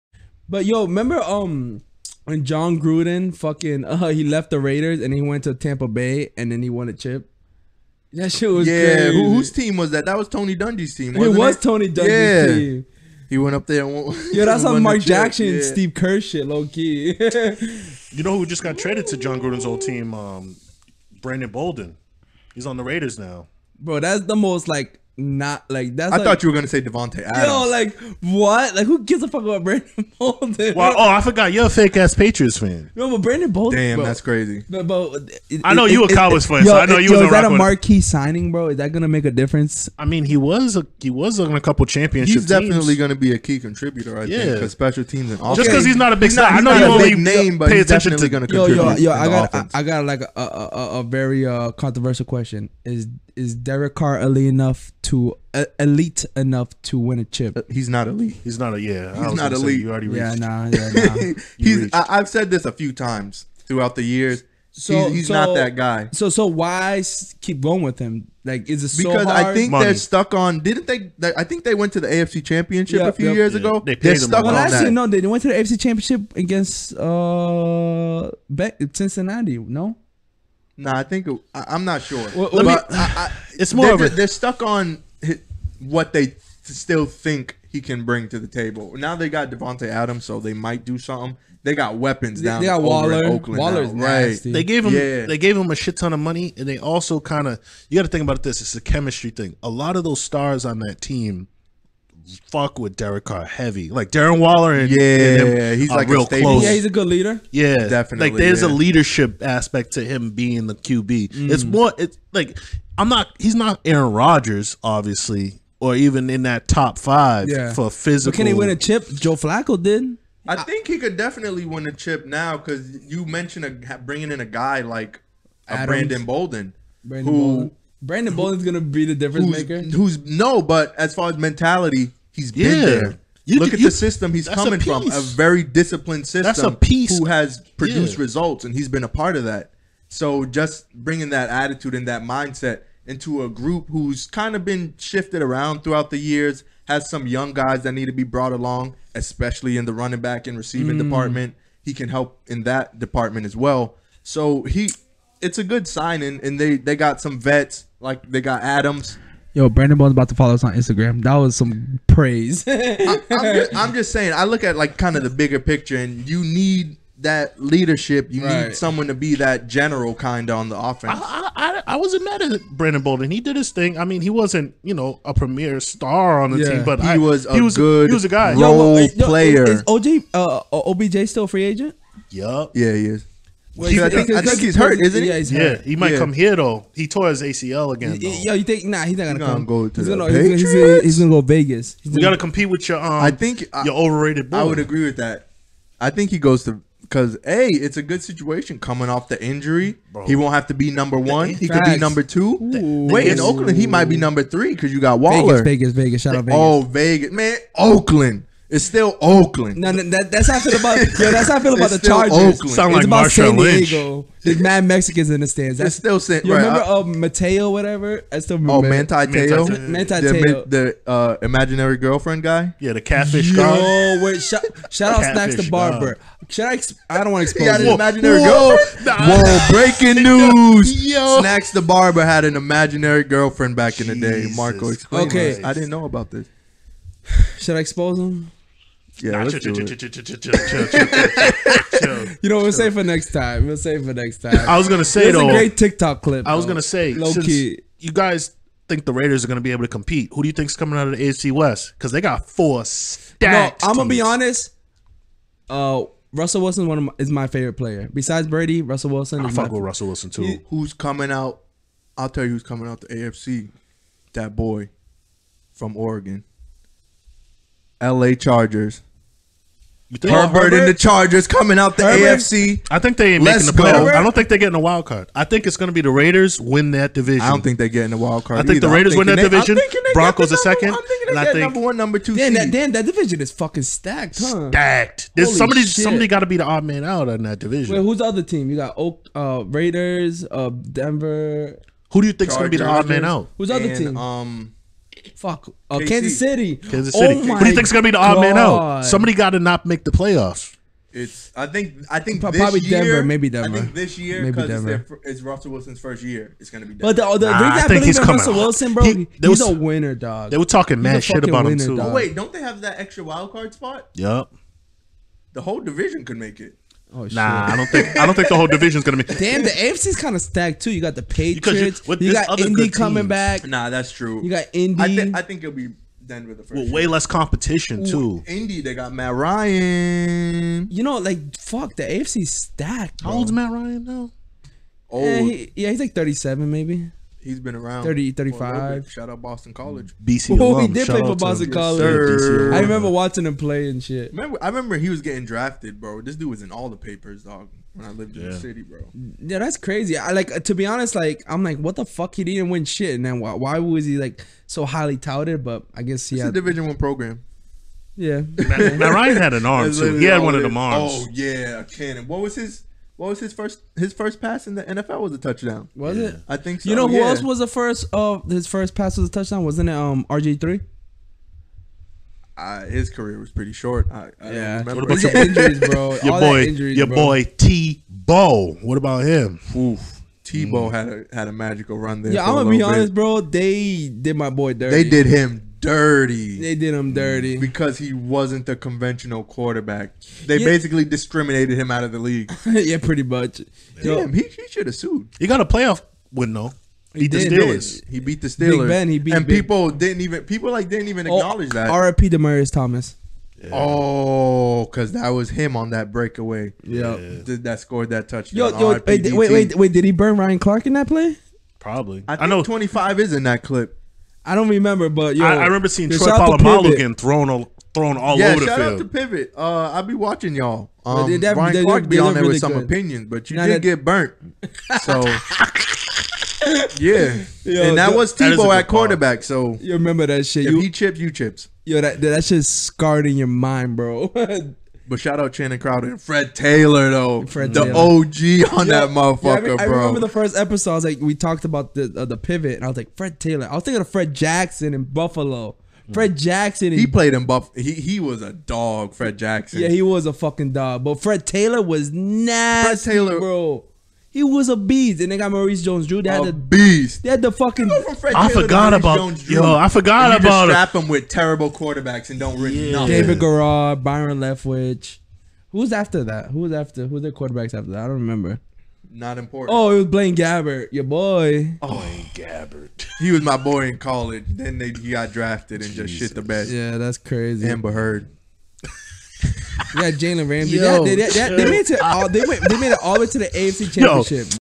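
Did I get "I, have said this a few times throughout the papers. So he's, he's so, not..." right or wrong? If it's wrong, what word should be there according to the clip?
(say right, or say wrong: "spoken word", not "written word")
wrong: "years", not "papers".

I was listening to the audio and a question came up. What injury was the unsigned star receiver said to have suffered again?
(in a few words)
ACL.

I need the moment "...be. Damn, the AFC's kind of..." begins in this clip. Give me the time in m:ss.
5:19.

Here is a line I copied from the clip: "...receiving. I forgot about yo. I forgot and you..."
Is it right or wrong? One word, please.
wrong.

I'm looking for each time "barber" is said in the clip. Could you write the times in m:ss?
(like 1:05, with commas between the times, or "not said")
3:45, 3:51.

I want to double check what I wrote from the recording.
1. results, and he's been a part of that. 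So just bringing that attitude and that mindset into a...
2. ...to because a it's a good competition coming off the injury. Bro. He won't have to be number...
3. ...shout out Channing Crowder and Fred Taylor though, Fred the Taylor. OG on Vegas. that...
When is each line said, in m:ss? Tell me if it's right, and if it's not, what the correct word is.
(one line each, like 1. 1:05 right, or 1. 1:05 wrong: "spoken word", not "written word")
1. 2:18 right
2. 3:16 wrong: "situation", not "competition"
3. 7:15 wrong: "Yeah", not "Vegas".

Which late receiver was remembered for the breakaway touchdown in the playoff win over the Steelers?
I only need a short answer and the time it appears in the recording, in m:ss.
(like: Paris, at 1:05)
Demaryius Thomas, at 6:41.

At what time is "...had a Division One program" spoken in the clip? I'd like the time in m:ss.
5:56.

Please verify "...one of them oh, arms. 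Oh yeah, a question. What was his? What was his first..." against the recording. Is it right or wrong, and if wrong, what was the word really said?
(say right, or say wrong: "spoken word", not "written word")
wrong: "cannon", not "question".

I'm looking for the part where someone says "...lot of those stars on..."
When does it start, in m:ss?
1:39.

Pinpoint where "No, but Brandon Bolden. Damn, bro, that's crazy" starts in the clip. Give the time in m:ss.
0:32.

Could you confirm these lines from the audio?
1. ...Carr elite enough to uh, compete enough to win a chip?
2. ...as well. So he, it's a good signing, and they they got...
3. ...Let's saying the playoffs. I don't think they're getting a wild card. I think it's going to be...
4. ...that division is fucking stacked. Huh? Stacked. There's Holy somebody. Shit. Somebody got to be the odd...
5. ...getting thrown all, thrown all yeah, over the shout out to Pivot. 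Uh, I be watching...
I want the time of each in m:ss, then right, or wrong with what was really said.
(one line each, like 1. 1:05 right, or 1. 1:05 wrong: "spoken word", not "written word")
1. 0:53 wrong: "elite", not "compete"
2. 2:33 right
3. 4:33 wrong: "making", not "saying"
4. 4:42 right
5. 6:56 right.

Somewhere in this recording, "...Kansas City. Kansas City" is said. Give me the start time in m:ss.
4:55.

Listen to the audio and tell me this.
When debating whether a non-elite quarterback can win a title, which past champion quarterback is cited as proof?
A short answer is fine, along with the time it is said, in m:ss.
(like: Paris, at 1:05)
Joe Flacco, at 1:59.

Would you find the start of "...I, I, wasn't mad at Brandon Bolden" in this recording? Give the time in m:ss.
2:51.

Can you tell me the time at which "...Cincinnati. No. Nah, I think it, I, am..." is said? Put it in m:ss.
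1:18.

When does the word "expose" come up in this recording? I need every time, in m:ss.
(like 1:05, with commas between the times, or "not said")
3:47, 3:57.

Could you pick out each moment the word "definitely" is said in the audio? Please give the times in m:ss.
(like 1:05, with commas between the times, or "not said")
0:42, 0:47, 1:47, 2:01.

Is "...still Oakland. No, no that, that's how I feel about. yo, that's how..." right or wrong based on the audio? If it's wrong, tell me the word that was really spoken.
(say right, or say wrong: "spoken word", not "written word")
right.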